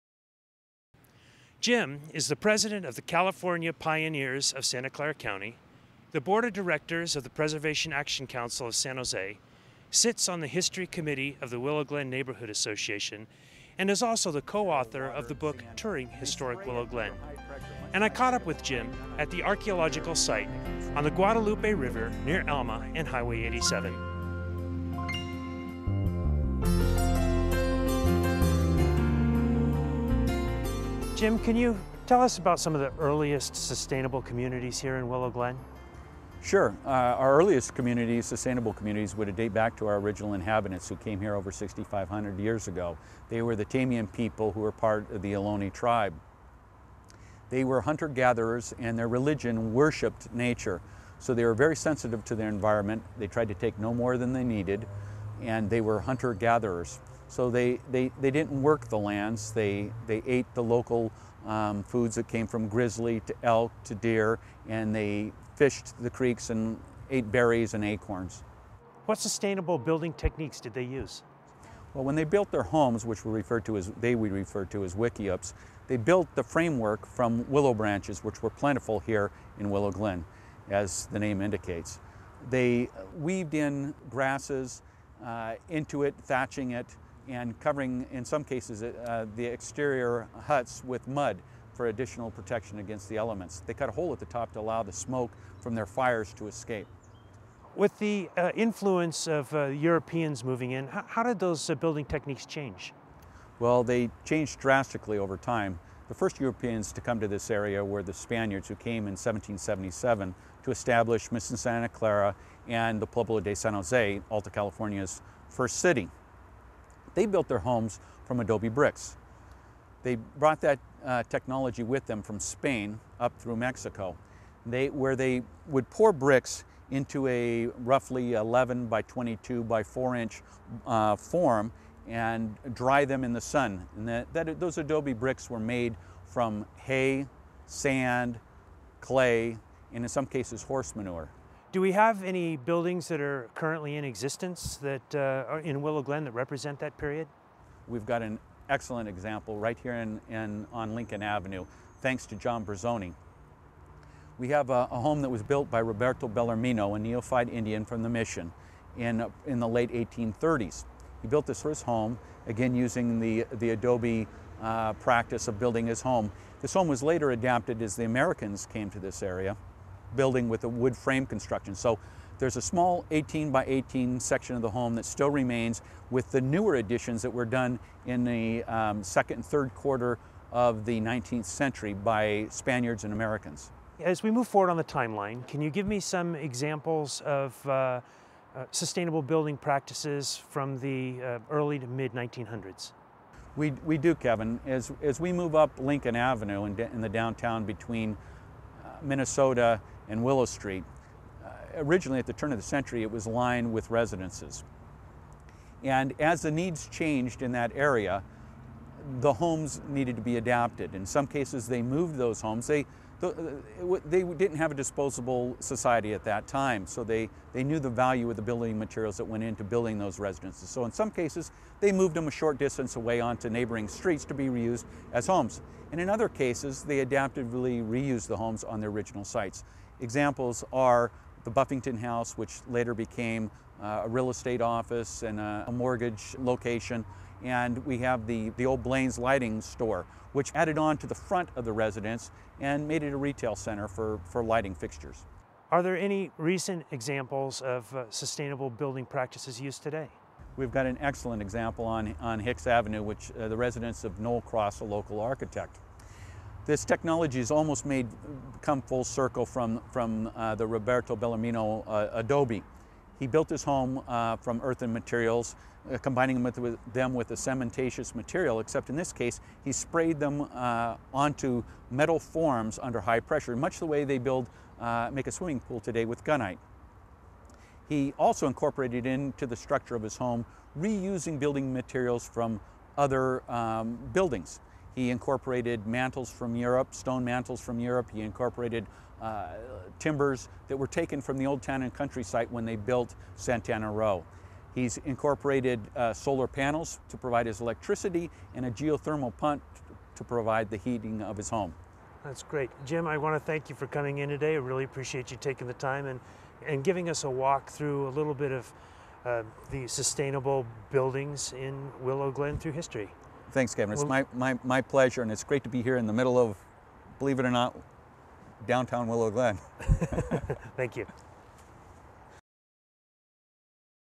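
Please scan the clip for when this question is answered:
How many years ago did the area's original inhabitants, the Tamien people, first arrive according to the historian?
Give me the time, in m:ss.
0:41.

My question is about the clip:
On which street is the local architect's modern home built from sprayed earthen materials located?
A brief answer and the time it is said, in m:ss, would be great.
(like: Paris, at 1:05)
Hicks Avenue, at 4:12.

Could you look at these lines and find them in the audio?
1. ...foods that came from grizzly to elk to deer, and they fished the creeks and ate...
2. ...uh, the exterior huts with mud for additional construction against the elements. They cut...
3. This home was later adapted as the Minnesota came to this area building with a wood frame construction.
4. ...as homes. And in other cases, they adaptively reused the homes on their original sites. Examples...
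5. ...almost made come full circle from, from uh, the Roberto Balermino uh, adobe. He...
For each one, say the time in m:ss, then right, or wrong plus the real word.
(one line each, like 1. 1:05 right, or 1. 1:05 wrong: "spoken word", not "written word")
1. 1:01 right
2. 1:28 wrong: "protection", not "construction"
3. 2:46 wrong: "Americans", not "Minnesota"
4. 3:45 right
5. 4:17 right.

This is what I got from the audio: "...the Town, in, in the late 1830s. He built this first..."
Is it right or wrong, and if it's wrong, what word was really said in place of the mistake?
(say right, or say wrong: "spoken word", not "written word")
wrong: "Mission", not "Town".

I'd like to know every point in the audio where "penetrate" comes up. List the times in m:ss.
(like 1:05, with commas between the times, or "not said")
not said.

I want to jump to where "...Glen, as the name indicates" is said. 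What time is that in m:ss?
1:19.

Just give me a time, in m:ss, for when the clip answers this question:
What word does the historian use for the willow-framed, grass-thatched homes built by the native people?
1:14.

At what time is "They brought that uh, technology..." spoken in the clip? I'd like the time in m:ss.
2:00.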